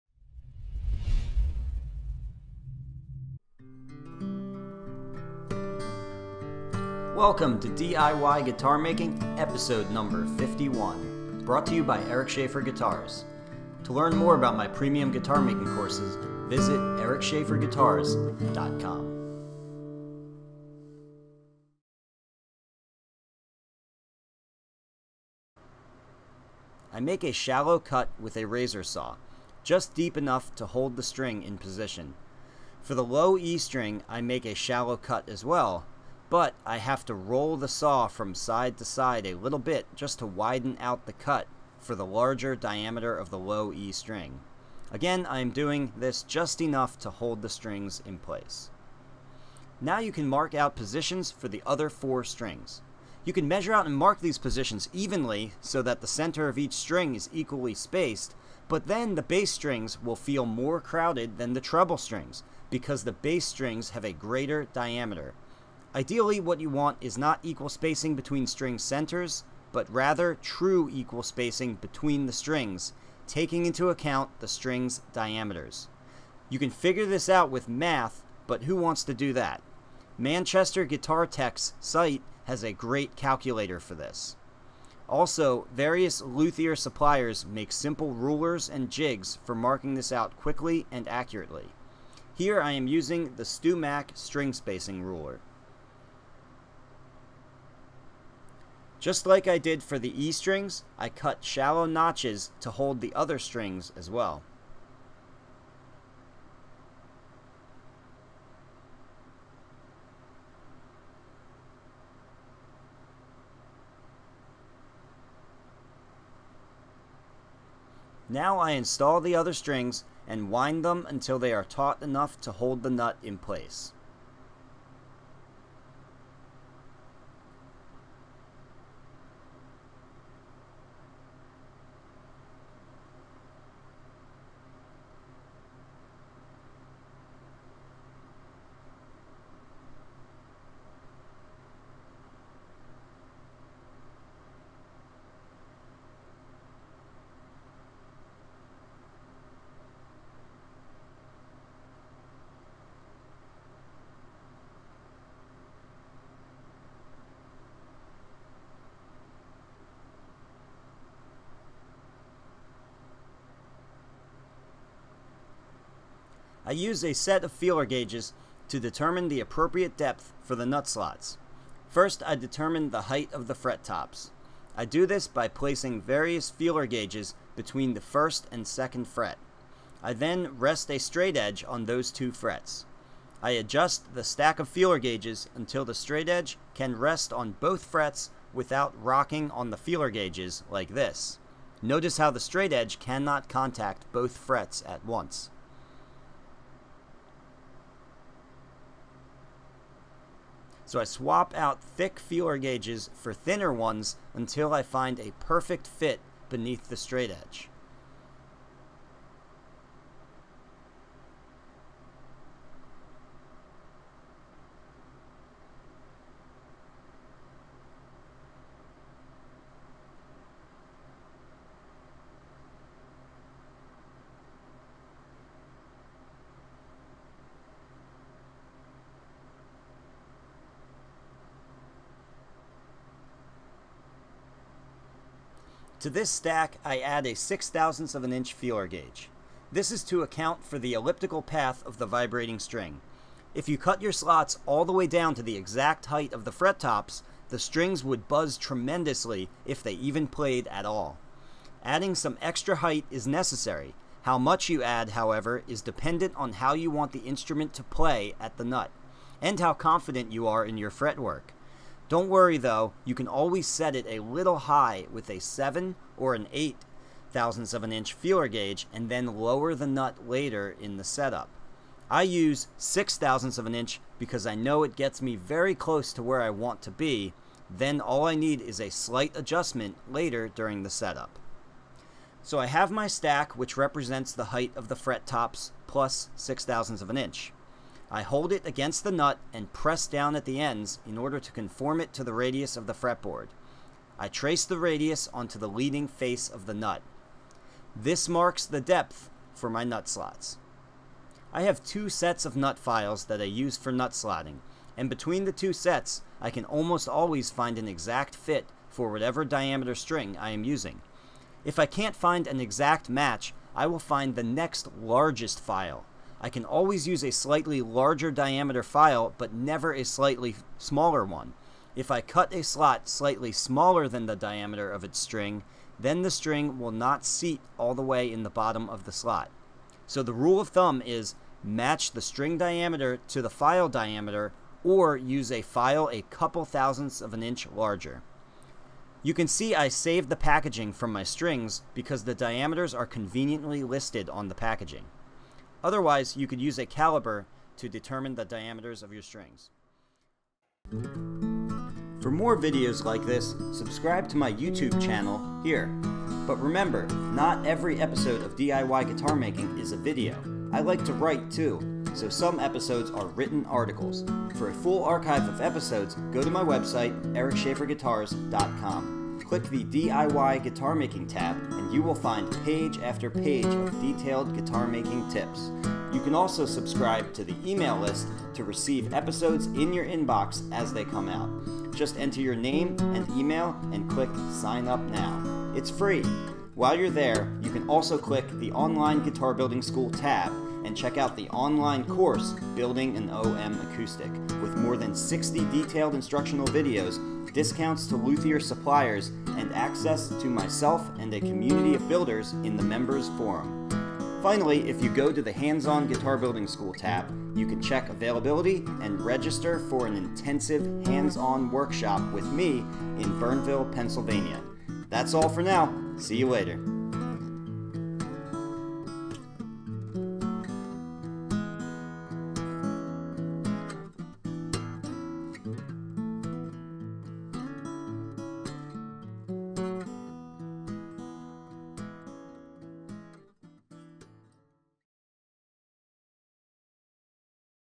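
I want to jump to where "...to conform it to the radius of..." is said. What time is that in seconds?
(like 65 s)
291 s.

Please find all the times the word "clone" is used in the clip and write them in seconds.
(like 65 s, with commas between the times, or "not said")
not said.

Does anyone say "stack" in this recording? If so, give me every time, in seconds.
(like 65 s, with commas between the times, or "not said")
184 s, 236 s, 283 s.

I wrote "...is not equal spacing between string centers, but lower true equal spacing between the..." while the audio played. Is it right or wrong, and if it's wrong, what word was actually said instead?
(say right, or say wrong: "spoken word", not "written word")
wrong: "rather", not "lower".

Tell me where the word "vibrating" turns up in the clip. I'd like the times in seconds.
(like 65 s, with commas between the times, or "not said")
242 s.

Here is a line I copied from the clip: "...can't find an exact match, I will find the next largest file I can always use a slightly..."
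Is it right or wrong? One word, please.
right.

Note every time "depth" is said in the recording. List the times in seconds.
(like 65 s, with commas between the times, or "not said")
169 s, 298 s.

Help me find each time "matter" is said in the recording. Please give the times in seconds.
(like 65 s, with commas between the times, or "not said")
not said.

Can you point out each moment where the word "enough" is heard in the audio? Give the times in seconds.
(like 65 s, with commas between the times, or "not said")
30 s, 46 s, 122 s.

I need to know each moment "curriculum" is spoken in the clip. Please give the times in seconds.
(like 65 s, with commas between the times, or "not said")
not said.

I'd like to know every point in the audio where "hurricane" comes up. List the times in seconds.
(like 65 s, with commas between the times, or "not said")
not said.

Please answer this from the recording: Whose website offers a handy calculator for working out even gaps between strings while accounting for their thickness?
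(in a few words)
Manchester Guitar Tech.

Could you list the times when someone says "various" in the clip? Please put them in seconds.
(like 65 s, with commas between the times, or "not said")
85 s, 176 s.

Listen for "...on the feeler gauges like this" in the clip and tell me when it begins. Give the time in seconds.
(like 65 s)
189 s.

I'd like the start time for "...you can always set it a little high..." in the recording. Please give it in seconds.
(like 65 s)
263 s.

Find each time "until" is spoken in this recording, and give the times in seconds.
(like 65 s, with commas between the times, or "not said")
121 s, 185 s, 204 s.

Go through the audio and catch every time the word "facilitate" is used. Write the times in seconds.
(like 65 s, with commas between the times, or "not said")
not said.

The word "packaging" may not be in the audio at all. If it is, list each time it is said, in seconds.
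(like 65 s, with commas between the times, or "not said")
340 s, 344 s.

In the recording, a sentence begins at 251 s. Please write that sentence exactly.
Adding some extra height is necessary.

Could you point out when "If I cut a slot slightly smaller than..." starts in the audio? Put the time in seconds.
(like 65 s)
321 s.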